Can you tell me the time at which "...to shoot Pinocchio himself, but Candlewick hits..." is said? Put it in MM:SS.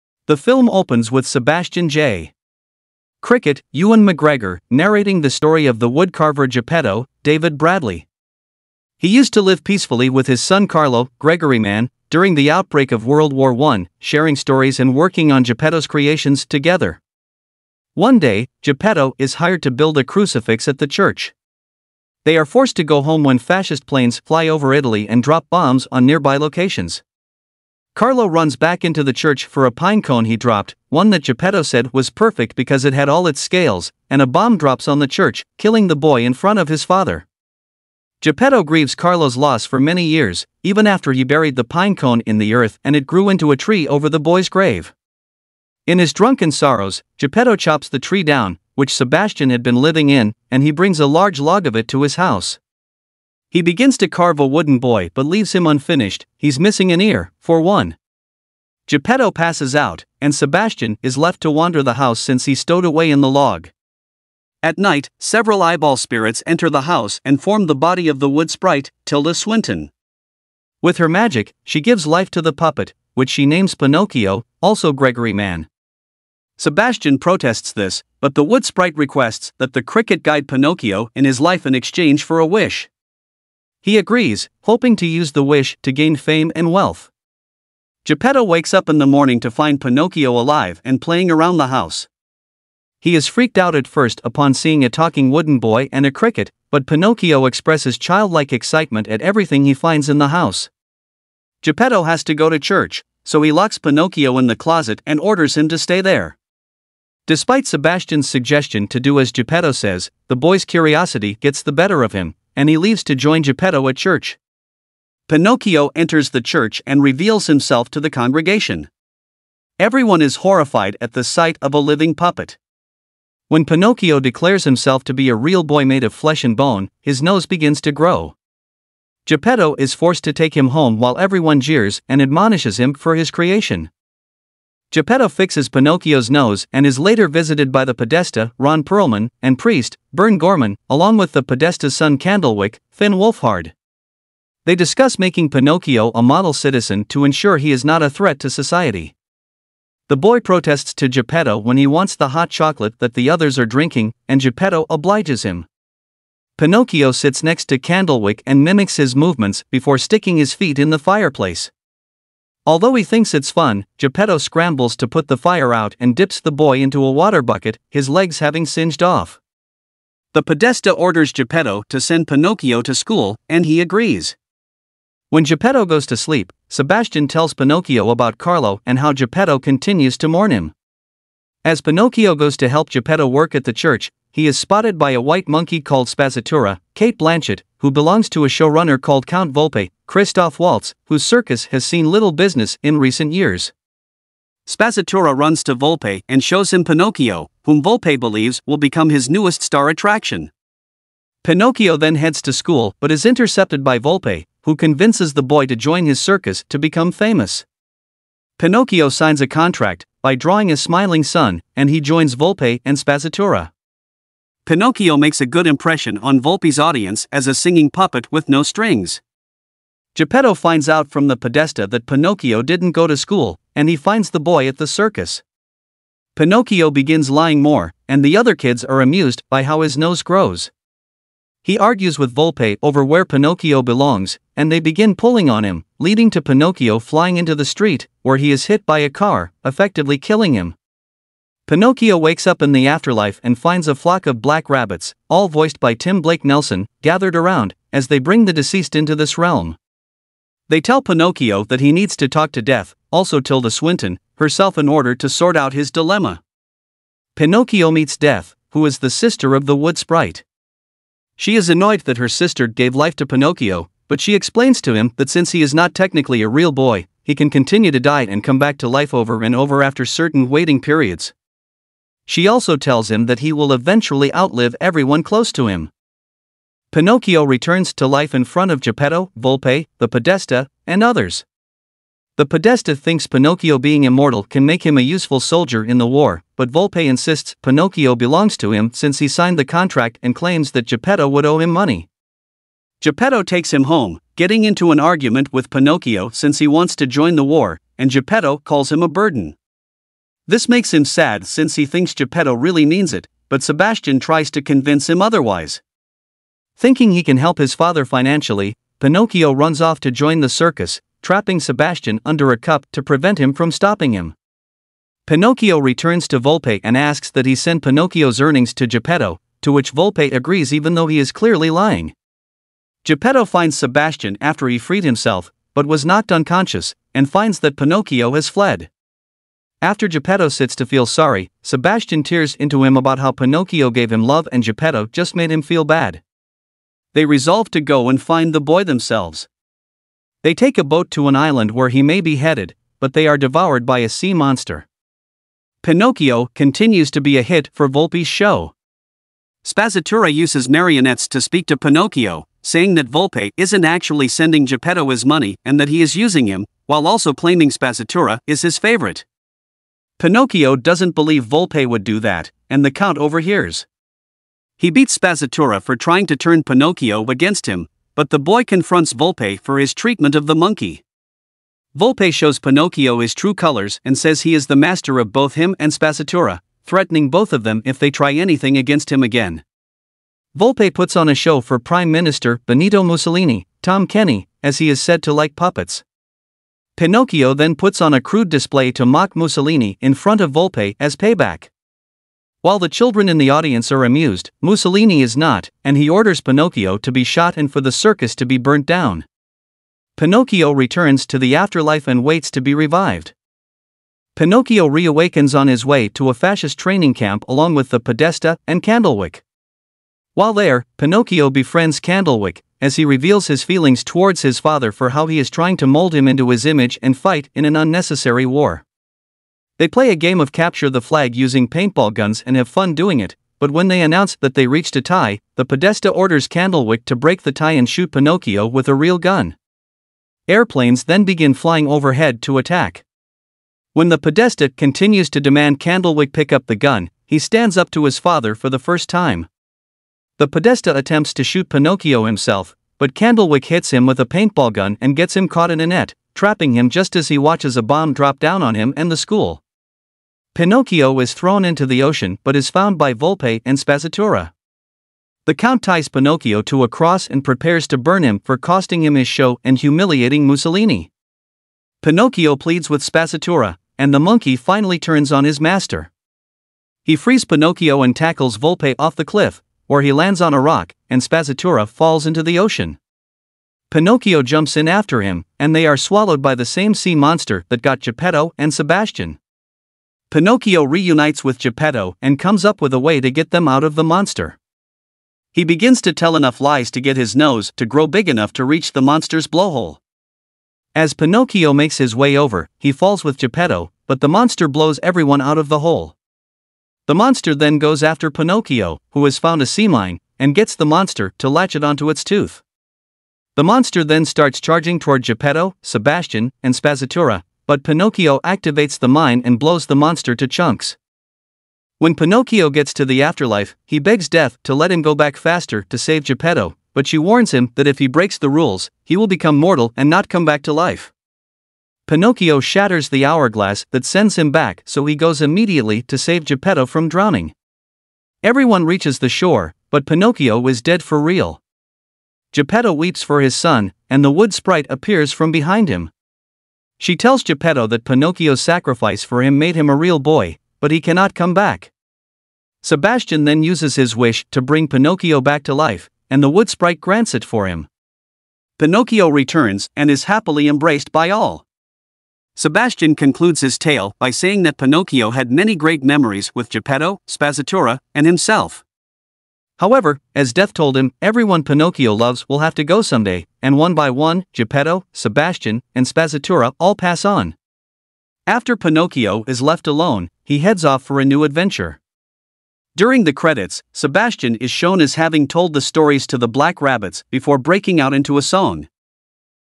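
07:21.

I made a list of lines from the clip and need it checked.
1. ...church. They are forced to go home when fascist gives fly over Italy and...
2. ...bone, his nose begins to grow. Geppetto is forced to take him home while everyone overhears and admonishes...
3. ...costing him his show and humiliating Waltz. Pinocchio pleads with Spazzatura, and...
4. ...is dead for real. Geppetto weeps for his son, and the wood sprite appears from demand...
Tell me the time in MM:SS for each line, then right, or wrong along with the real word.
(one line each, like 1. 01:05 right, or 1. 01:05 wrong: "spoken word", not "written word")
1. 00:20 wrong: "planes", not "gives"
2. 02:06 wrong: "jeers", not "overhears"
3. 07:38 wrong: "Mussolini", not "Waltz"
4. 08:50 wrong: "behind", not "demand".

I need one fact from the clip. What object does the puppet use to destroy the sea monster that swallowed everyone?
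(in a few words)
sea mine.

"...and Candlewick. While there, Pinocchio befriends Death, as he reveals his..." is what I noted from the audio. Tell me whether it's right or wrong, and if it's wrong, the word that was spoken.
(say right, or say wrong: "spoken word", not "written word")
wrong: "Candlewick", not "Death".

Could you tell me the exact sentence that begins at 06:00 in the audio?
Pinocchio doesn't believe Volpe would do that, and the Count overhears.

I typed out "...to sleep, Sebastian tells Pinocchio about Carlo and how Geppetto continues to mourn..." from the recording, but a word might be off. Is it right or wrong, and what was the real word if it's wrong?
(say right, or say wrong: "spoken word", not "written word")
right.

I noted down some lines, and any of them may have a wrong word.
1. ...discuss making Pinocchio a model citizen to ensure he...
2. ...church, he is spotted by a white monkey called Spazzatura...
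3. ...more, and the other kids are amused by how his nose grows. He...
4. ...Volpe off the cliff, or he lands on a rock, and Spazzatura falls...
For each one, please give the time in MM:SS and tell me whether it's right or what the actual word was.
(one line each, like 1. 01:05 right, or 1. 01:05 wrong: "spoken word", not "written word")
1. 02:24 right
2. 03:03 right
3. 03:47 right
4. 07:48 right.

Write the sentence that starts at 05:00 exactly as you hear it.
This makes him sad since he thinks Geppetto really means it, but Sebastian tries to convince him otherwise.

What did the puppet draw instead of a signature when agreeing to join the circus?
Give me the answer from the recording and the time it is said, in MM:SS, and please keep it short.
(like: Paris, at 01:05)
a smiling sun, at 03:30.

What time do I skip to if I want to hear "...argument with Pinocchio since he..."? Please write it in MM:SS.
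04:55.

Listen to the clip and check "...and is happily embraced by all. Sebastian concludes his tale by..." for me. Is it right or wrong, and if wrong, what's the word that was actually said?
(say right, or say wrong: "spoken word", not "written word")
right.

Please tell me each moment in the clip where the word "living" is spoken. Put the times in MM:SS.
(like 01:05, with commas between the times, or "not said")
00:49, 02:01.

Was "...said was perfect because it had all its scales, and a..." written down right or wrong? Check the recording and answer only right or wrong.
right.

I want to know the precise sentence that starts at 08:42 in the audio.
Pinocchio shatters the hourglass that sends him back, so he goes immediately to save Geppetto from drowning.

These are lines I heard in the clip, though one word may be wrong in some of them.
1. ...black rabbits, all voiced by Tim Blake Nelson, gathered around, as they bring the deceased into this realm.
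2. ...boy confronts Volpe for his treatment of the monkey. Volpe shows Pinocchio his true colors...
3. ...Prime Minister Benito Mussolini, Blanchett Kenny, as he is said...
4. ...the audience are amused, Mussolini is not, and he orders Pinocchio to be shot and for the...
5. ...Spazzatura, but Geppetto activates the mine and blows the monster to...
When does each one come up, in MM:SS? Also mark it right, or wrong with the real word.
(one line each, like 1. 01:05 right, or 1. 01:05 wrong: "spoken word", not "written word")
1. 04:04 right
2. 06:08 right
3. 06:21 wrong: "Tom", not "Blanchett"
4. 06:33 right
5. 08:26 wrong: "Pinocchio", not "Geppetto".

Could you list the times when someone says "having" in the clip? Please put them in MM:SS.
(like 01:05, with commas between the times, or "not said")
02:48, 09:35.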